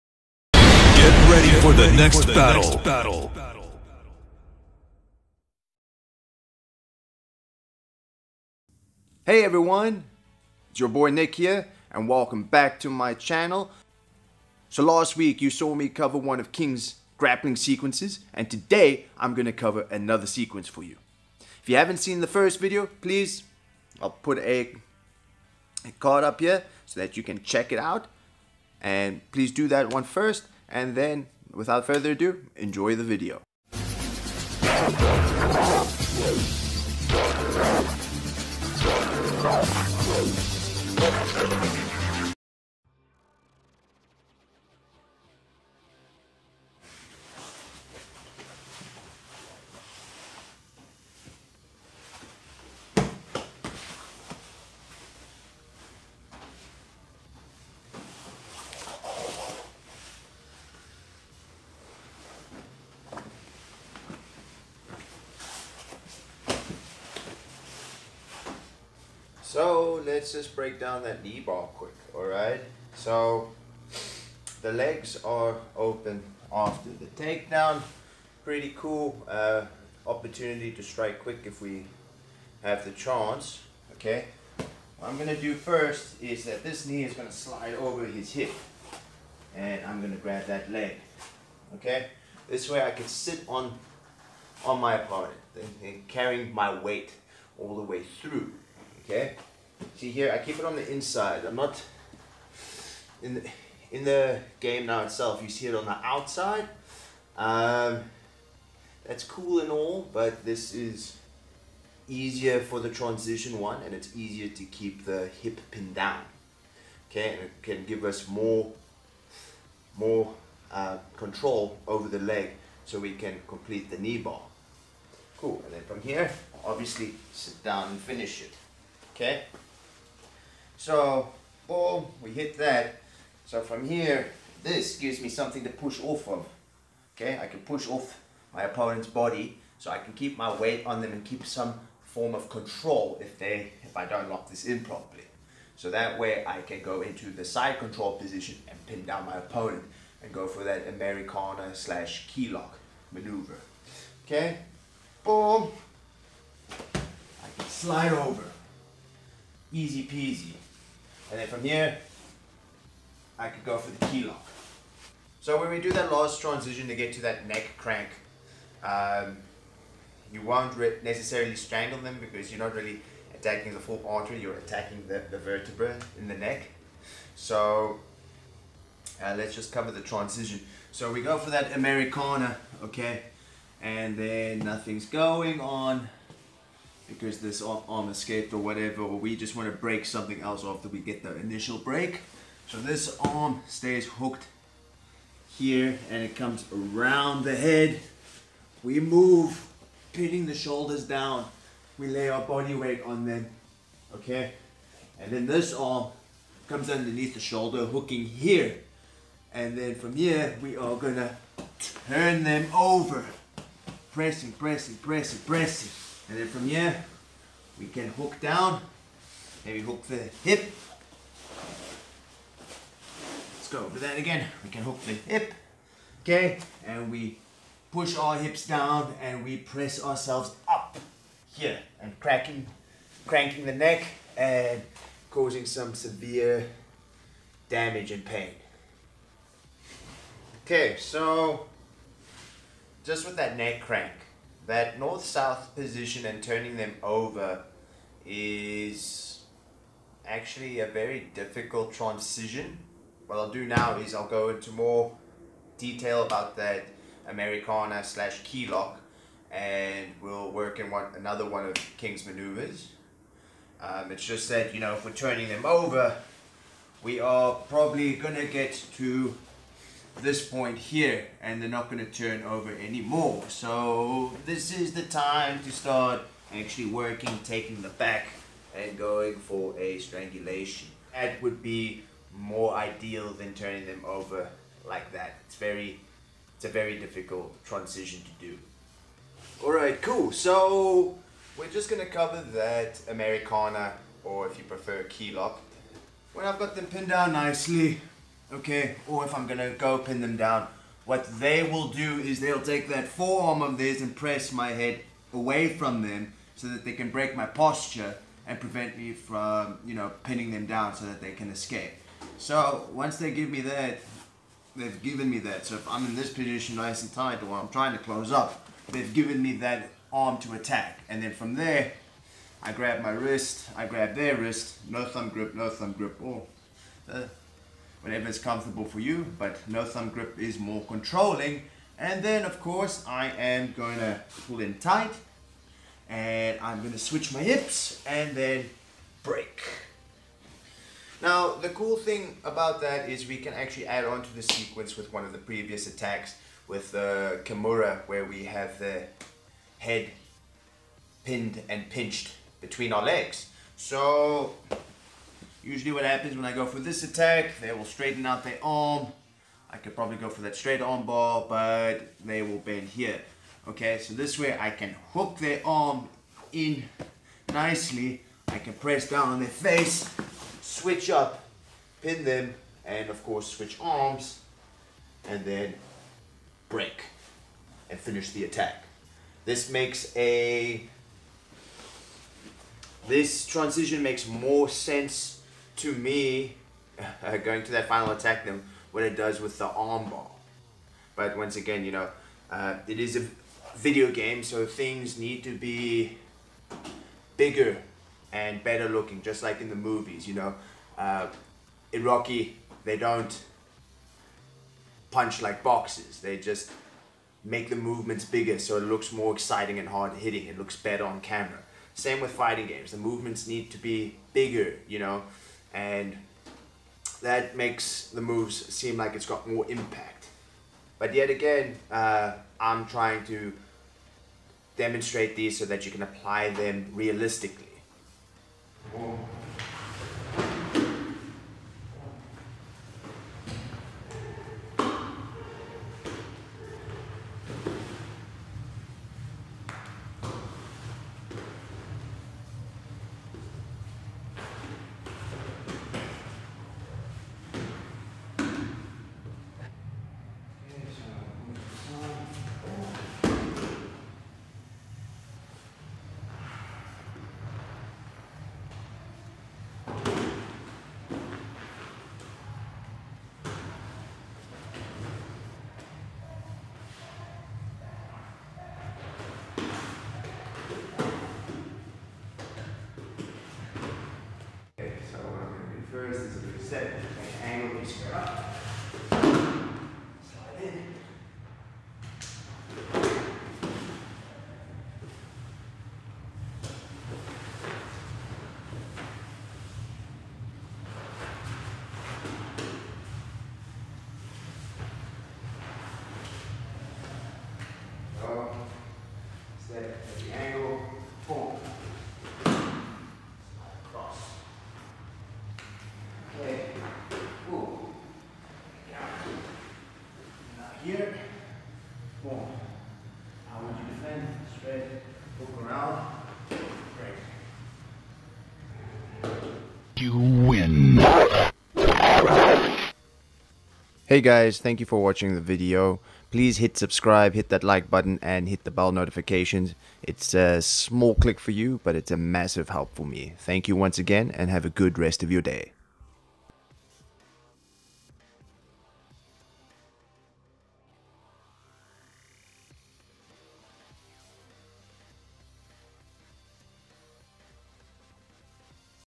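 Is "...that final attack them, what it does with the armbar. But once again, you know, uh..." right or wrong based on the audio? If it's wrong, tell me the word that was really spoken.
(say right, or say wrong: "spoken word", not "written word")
right.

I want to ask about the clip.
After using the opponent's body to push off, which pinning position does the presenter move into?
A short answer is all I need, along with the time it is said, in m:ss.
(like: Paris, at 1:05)
side control, at 2:27.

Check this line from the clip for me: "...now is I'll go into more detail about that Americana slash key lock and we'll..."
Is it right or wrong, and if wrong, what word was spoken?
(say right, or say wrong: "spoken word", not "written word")
right.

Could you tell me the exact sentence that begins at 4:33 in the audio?
So this is the time to start actually working, taking the back and going for a strangulation.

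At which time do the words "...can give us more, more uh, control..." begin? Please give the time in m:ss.
1:57.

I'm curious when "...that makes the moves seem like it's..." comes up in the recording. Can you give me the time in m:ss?
6:57.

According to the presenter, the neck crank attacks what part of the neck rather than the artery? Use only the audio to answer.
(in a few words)
the vertebra.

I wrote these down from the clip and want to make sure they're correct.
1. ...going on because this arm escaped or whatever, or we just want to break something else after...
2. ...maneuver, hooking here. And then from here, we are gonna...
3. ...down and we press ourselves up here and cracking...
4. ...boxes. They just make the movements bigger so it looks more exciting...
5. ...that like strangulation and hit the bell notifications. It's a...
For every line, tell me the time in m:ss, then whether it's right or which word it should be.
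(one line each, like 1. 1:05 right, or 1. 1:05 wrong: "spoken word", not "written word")
1. 3:05 right
2. 3:27 wrong: "shoulder", not "maneuver"
3. 3:48 right
4. 6:45 right
5. 8:47 wrong: "button", not "strangulation".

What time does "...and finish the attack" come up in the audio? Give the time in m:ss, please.
6:17.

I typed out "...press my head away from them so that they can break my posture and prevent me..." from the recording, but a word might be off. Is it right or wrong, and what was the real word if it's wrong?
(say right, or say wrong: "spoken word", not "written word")
right.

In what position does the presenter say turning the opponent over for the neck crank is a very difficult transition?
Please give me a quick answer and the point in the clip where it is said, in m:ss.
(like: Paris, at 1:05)
north-south, at 4:04.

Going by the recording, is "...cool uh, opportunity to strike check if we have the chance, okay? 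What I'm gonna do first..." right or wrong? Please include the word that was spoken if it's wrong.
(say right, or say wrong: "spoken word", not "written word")
wrong: "quick", not "check".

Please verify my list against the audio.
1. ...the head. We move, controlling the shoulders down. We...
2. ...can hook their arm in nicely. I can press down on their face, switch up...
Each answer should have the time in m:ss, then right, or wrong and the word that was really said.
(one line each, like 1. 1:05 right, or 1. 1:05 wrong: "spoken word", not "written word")
1. 3:17 wrong: "pinning", not "controlling"
2. 6:04 right.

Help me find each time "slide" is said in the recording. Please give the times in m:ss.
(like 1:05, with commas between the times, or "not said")
1:27, 2:37.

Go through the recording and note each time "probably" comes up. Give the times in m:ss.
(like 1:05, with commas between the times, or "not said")
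4:27, 5:59.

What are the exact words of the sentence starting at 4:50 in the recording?
So we're just going to cover that Americana or if you prefer key lock.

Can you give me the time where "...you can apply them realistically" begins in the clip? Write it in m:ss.
7:05.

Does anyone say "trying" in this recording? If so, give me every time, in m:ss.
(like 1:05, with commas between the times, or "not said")
5:17, 7:02.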